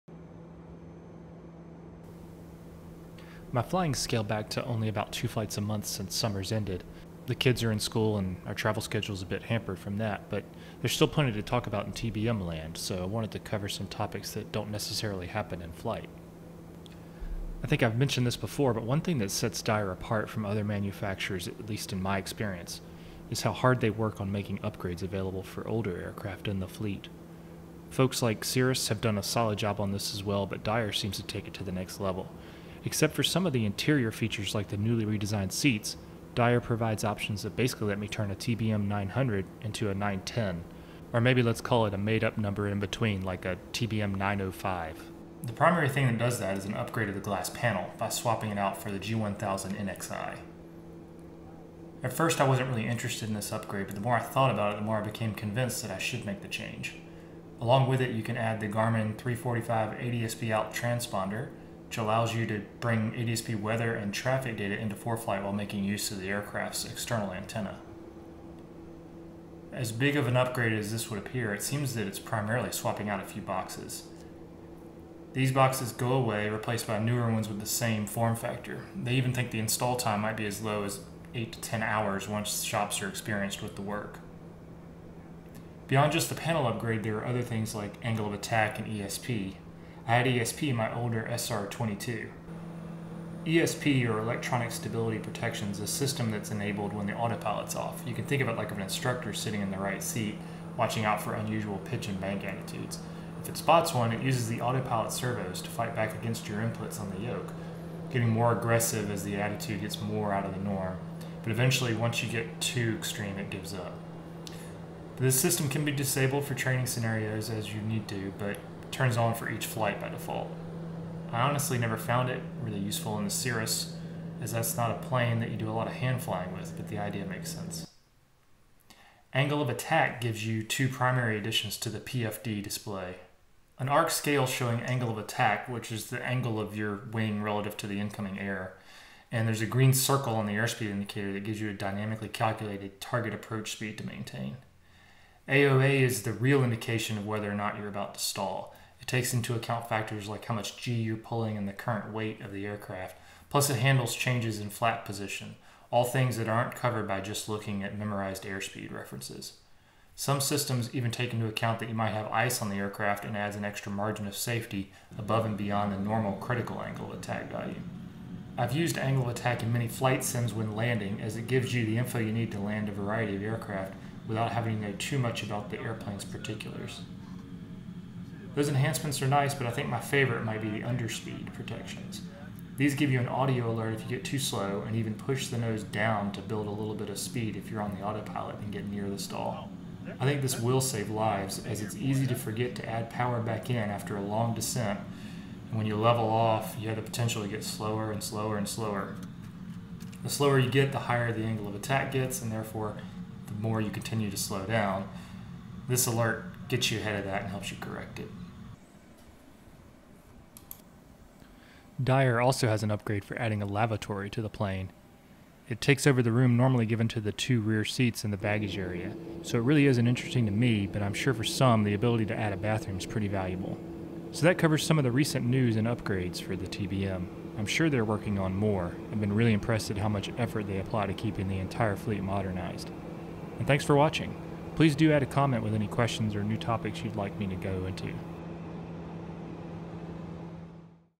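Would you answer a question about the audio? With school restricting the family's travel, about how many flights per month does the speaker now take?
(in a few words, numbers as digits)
2.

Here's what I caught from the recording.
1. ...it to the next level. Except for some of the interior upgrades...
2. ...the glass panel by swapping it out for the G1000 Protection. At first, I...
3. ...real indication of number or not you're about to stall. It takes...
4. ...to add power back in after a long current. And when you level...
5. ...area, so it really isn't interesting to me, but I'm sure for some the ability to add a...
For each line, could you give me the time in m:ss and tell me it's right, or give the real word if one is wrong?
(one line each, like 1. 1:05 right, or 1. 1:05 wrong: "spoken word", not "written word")
1. 0:31 wrong: "features", not "upgrades"
2. 0:47 wrong: "NXI", not "Protection"
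3. 2:26 wrong: "whether", not "number"
4. 3:12 wrong: "descent", not "current"
5. 3:38 right.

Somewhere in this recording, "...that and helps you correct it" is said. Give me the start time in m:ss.
3:27.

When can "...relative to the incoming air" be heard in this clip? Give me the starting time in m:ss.
2:17.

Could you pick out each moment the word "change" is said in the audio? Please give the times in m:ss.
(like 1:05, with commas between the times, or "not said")
0:56, 2:34.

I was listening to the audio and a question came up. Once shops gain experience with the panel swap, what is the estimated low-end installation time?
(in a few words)
8 to 10 hours.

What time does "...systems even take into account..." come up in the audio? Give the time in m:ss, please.
2:40.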